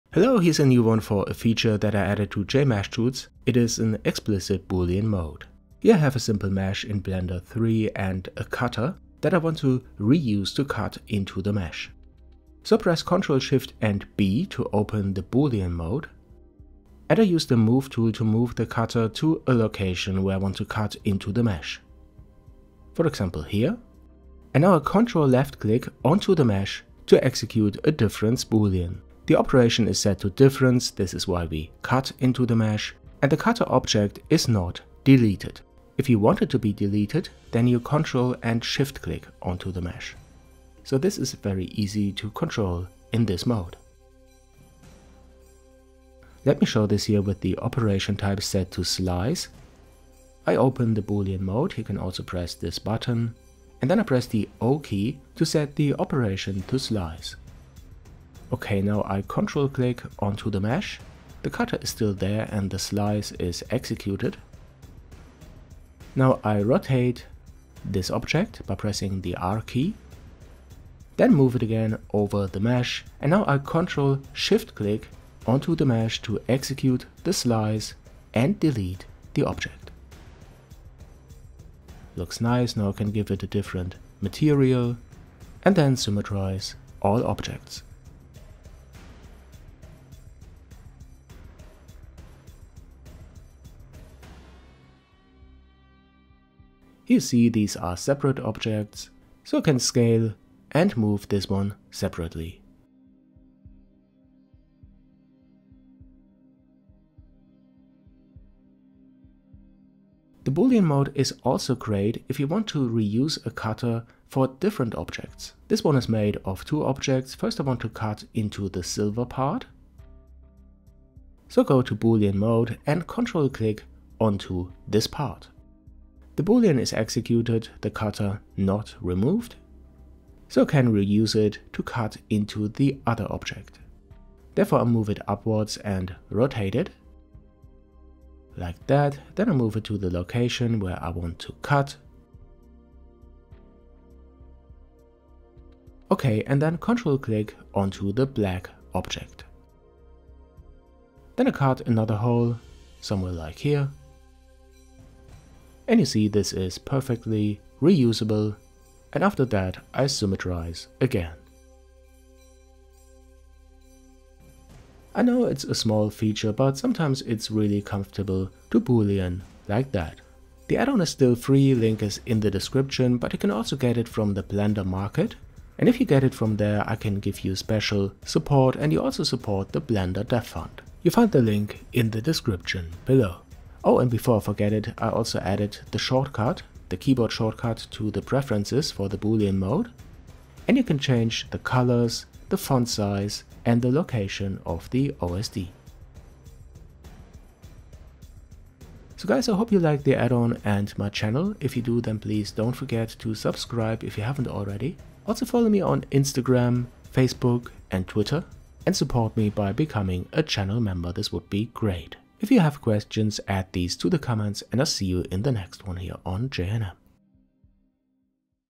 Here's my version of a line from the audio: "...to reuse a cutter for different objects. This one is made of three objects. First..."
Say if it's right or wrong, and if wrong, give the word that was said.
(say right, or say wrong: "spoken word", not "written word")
wrong: "two", not "three".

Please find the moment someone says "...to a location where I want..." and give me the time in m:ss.
0:19.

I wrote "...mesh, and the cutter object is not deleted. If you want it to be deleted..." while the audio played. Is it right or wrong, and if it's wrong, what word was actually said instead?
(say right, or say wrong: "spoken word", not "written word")
right.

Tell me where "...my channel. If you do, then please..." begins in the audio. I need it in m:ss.
3:20.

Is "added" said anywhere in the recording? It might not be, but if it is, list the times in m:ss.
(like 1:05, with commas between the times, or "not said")
0:02, 3:05.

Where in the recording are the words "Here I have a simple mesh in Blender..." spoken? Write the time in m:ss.
0:05.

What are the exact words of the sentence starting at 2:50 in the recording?
The add-on is still free, link is in the description, but you can also get it from the Blender Market.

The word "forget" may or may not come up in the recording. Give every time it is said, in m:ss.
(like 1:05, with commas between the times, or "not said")
3:04, 3:22.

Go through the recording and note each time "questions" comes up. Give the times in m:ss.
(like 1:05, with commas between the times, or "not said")
3:32.